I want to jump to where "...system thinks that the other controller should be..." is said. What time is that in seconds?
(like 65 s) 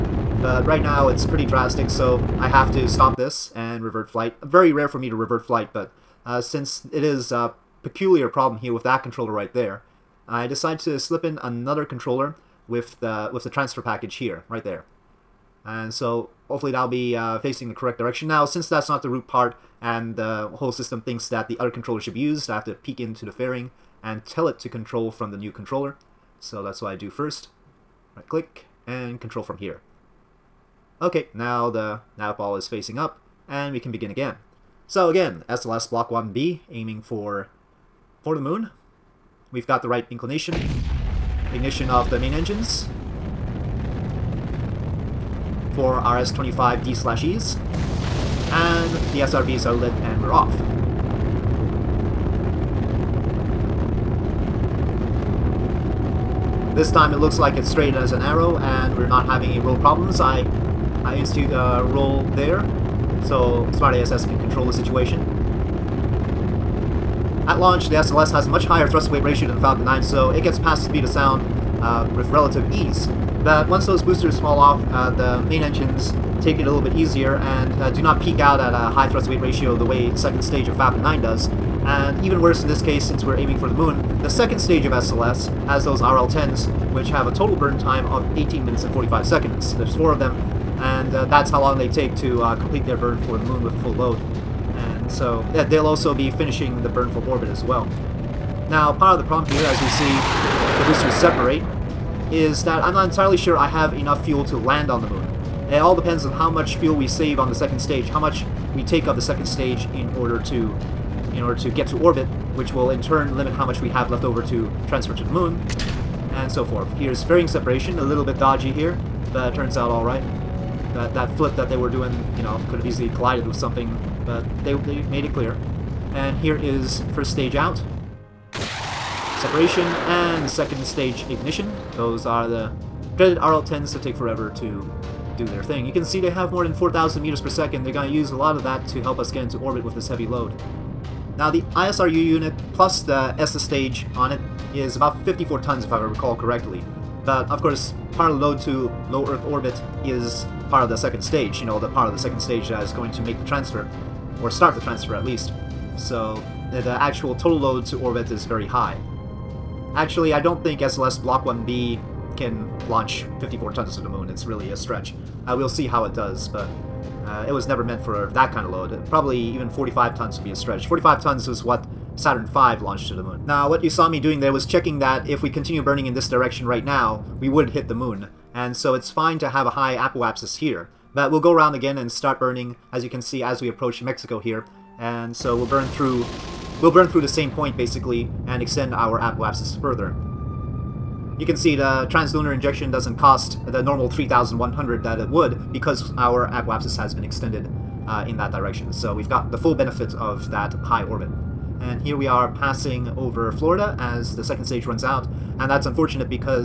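20 s.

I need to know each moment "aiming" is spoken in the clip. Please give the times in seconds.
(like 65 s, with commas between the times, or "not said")
36 s, 83 s.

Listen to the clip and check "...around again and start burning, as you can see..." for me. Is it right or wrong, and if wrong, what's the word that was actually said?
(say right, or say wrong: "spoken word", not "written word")
right.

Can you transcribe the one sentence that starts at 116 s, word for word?
Here's fairing separation, a little bit dodgy here, but turns out alright.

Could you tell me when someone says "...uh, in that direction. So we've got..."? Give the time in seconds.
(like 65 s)
198 s.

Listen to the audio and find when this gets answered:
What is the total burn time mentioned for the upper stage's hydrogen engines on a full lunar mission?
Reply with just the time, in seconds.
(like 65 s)
88 s.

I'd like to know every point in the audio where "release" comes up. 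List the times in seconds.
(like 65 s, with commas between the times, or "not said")
not said.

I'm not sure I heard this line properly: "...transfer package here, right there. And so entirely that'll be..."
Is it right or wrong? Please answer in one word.
wrong.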